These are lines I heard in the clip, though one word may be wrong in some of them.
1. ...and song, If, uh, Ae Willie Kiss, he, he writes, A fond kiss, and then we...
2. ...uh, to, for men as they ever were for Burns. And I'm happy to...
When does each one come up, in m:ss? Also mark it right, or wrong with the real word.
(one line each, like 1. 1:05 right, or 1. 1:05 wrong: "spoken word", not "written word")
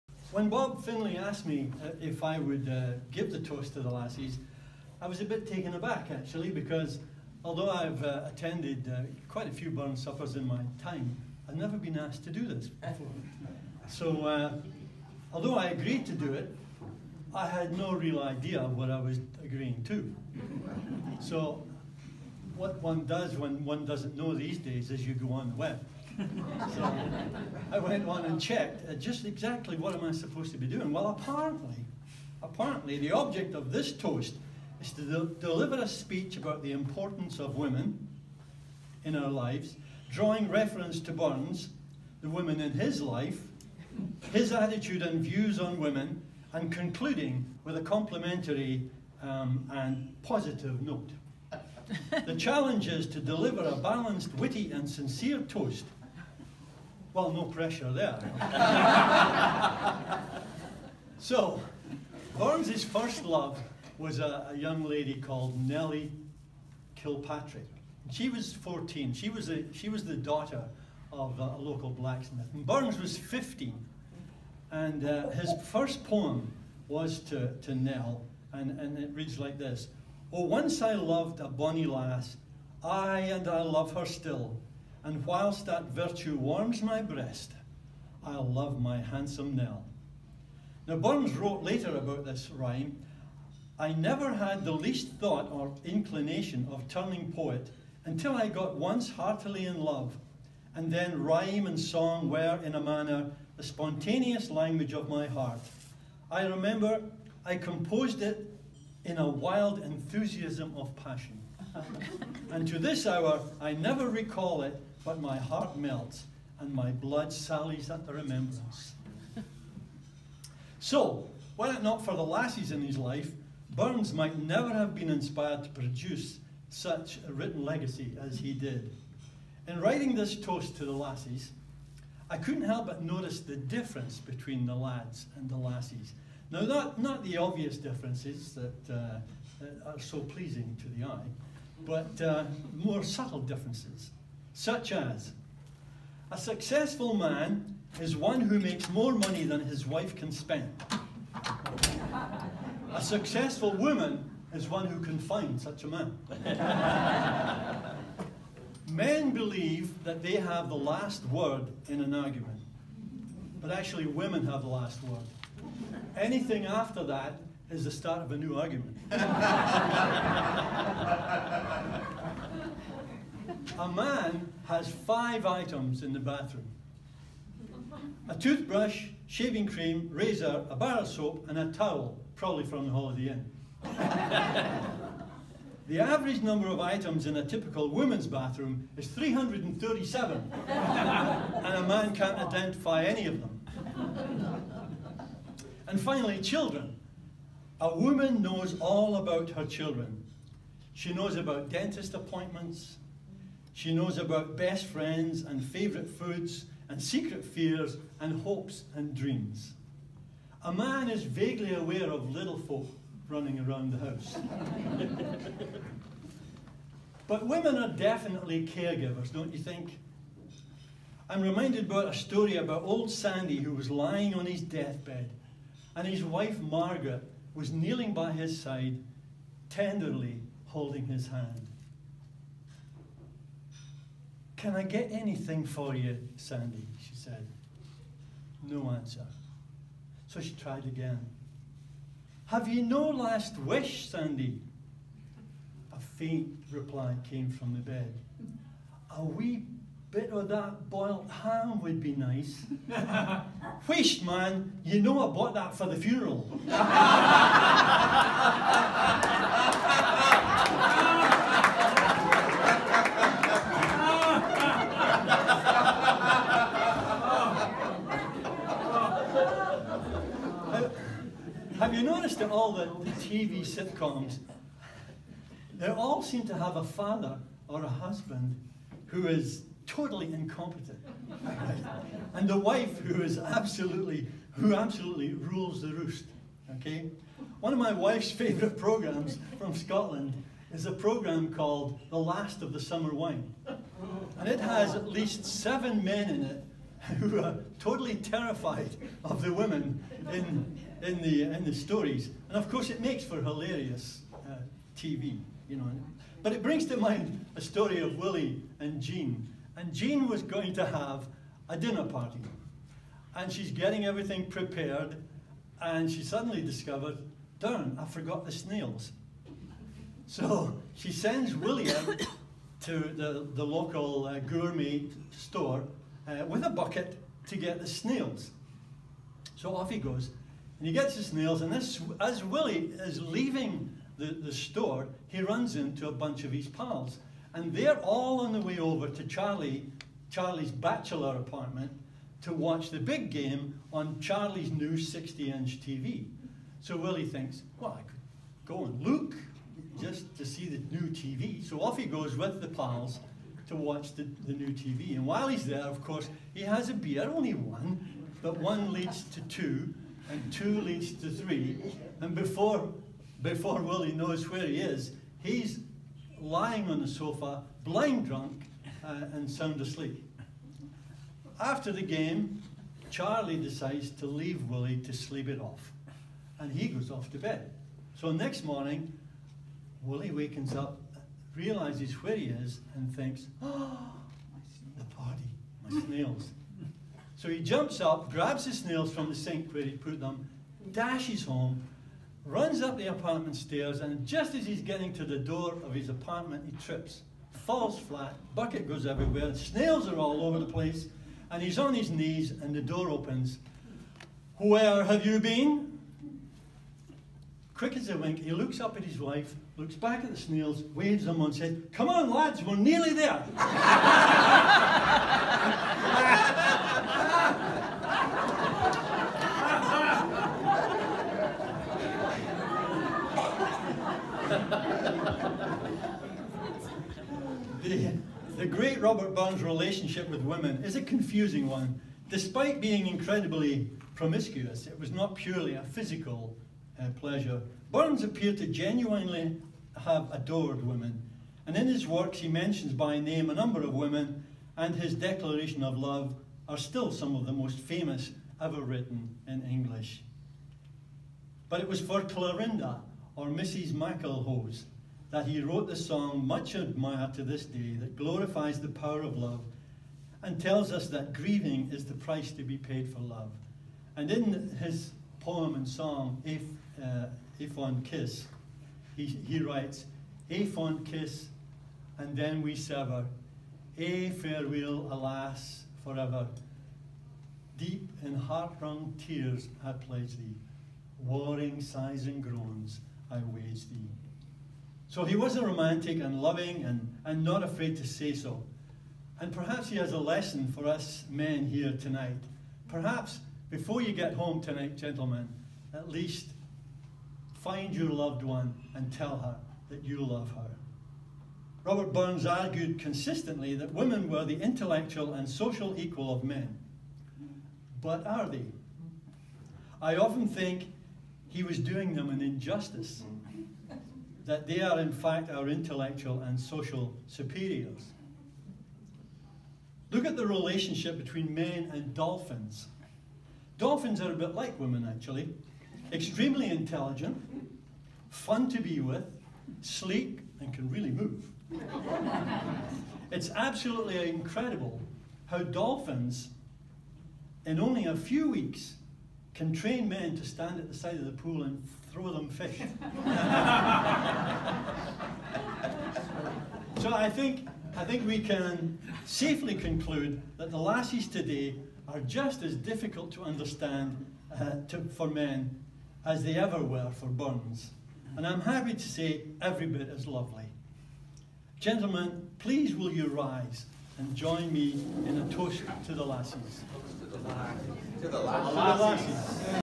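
1. 7:45 wrong: "Fond", not "Willie"
2. 9:14 right.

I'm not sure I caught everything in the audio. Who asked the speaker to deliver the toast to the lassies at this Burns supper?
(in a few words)
Bob Finley.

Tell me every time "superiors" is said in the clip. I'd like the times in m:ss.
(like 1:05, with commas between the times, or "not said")
8:37.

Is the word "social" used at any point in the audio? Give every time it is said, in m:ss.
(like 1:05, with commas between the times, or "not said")
8:25, 8:36.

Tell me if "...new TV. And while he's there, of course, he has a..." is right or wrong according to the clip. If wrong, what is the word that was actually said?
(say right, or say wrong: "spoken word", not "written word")
right.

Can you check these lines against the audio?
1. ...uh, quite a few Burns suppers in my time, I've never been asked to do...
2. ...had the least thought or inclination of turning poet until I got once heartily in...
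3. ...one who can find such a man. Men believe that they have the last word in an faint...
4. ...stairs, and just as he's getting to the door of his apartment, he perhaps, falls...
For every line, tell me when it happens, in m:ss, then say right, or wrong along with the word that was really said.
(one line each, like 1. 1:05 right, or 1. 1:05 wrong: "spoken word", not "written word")
1. 0:08 right
2. 1:34 right
3. 2:34 wrong: "argument", not "faint"
4. 6:33 wrong: "trips", not "perhaps".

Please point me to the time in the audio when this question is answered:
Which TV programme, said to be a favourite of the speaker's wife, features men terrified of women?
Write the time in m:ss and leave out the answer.
4:52.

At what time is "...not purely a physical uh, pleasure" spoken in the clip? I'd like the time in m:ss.
7:15.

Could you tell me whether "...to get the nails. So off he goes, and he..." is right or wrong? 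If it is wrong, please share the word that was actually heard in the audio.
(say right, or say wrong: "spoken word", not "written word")
wrong: "snails", not "nails".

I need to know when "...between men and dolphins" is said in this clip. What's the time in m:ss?
8:41.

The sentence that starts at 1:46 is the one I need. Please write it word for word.
I remember I composed it in a wild enthusiasm of passion.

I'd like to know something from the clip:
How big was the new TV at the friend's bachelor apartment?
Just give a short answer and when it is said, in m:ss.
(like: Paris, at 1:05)
60-inch, at 5:44.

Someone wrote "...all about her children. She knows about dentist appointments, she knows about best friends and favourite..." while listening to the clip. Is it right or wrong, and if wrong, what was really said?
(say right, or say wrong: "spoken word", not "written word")
right.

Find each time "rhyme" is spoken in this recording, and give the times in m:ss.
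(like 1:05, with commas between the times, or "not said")
1:32, 1:41.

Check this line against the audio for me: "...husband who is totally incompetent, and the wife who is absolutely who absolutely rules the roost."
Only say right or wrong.
right.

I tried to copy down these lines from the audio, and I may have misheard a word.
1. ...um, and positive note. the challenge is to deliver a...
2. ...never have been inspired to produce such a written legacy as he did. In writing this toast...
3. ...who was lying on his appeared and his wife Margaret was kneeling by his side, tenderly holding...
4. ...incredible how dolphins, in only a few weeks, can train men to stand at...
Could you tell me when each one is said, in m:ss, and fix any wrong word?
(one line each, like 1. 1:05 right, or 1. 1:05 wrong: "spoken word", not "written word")
1. 0:49 right
2. 2:04 right
3. 3:43 wrong: "deathbed", not "appeared"
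4. 8:54 right.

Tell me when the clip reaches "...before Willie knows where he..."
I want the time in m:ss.
6:03.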